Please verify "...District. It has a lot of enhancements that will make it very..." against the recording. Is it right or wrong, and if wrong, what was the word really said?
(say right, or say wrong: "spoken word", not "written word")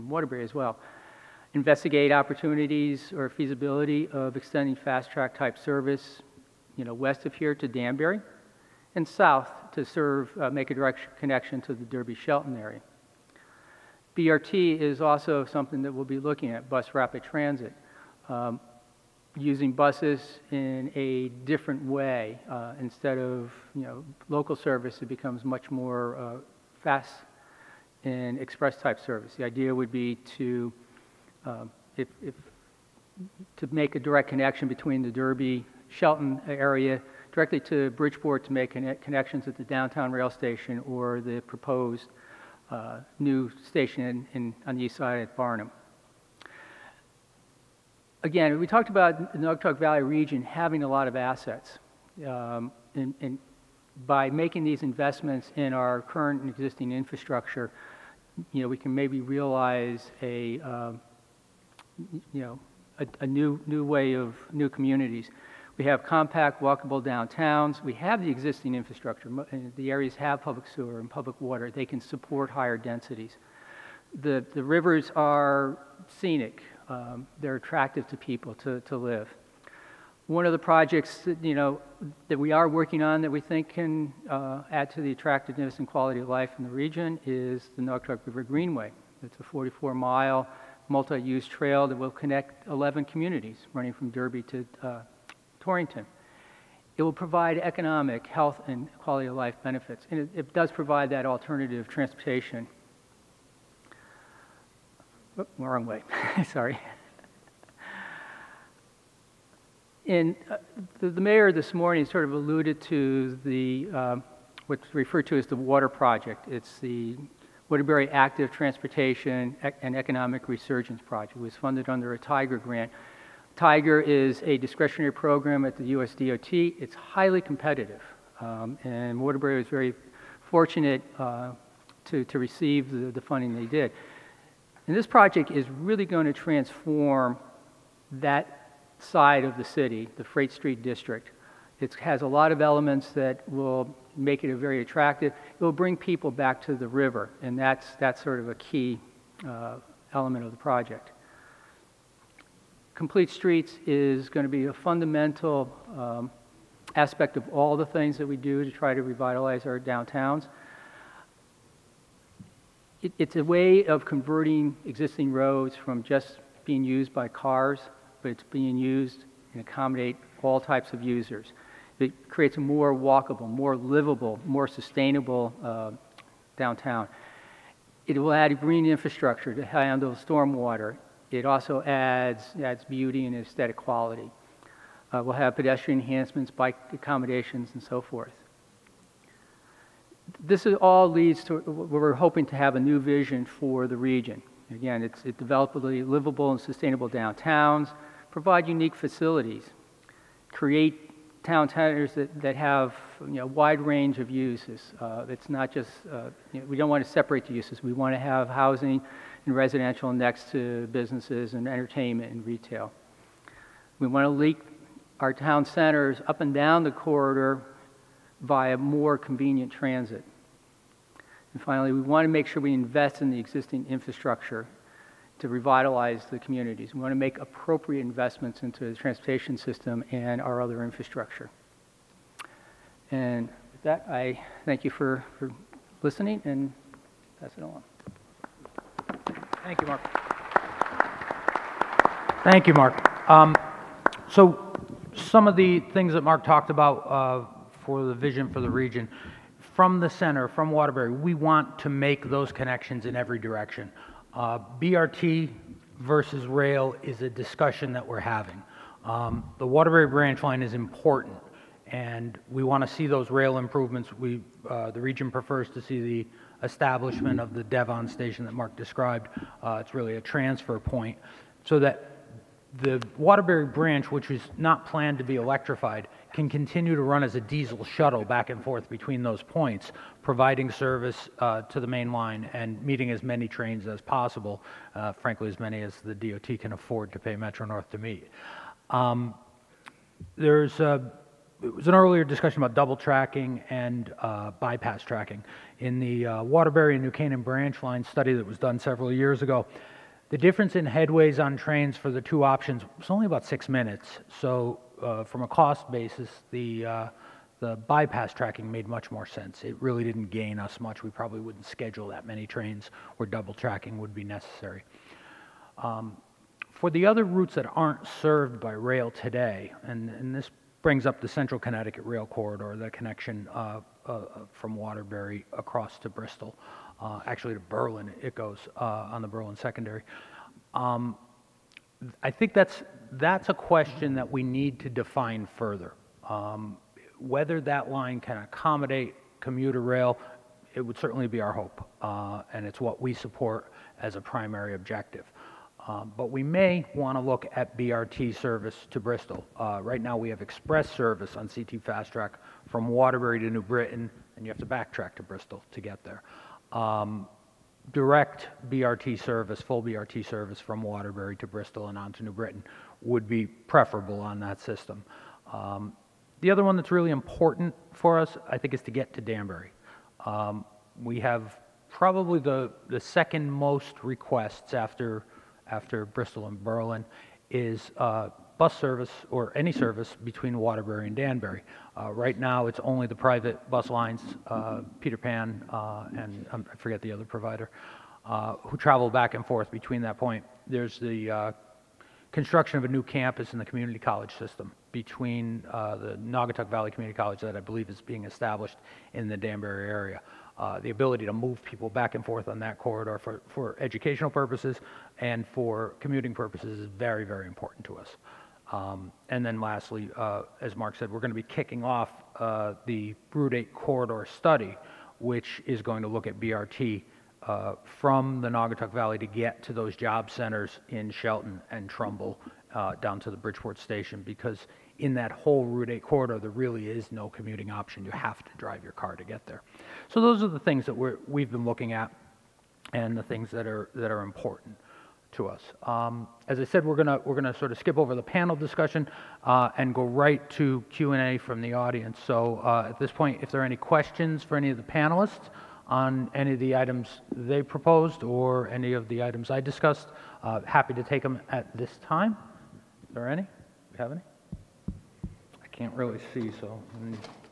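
wrong: "elements", not "enhancements".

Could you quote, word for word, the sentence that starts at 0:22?
Uh, instead of you know, local service, it becomes much more uh, fast and express type service.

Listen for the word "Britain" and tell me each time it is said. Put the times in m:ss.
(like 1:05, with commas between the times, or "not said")
5:53, 6:02.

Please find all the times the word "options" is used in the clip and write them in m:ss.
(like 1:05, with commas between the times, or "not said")
5:02, 7:07.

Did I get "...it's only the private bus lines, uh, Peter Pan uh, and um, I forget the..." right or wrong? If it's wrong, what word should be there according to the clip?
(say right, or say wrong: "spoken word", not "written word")
right.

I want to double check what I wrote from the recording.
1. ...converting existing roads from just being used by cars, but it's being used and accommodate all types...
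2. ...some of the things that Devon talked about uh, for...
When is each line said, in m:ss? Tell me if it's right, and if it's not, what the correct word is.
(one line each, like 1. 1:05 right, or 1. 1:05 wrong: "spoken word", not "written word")
1. 2:44 right
2. 4:05 wrong: "Mark", not "Devon".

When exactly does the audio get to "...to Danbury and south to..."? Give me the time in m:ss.
0:07.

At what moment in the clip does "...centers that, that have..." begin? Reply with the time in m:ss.
3:21.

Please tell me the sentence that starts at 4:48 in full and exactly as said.
Um, there's a, it was an earlier discussion about double tracking and uh, bypass tracking.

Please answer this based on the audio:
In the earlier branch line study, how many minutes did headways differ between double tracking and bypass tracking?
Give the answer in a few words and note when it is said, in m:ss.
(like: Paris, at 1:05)
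6 minutes, at 5:03.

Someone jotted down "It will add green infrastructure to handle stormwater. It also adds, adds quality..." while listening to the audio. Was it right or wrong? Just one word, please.
wrong.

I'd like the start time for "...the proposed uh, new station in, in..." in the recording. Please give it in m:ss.
0:41.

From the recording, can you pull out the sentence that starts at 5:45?
Um, but we may want to look at BRT service to Bristol.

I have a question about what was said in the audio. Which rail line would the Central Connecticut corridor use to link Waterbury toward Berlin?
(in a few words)
Berlin Secondary.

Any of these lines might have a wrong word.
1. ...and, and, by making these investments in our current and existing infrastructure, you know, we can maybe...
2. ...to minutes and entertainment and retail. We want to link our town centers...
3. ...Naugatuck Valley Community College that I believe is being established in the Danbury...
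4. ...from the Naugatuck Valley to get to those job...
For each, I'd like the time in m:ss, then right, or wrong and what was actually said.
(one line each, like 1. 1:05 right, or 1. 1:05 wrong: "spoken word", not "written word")
1. 0:52 right
2. 3:30 wrong: "businesses", not "minutes"
3. 6:36 right
4. 6:57 right.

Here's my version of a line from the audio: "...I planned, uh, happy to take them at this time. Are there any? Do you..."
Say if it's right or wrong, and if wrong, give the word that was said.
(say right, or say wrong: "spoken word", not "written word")
wrong: "discussed", not "planned".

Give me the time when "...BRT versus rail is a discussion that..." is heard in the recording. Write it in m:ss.
4:14.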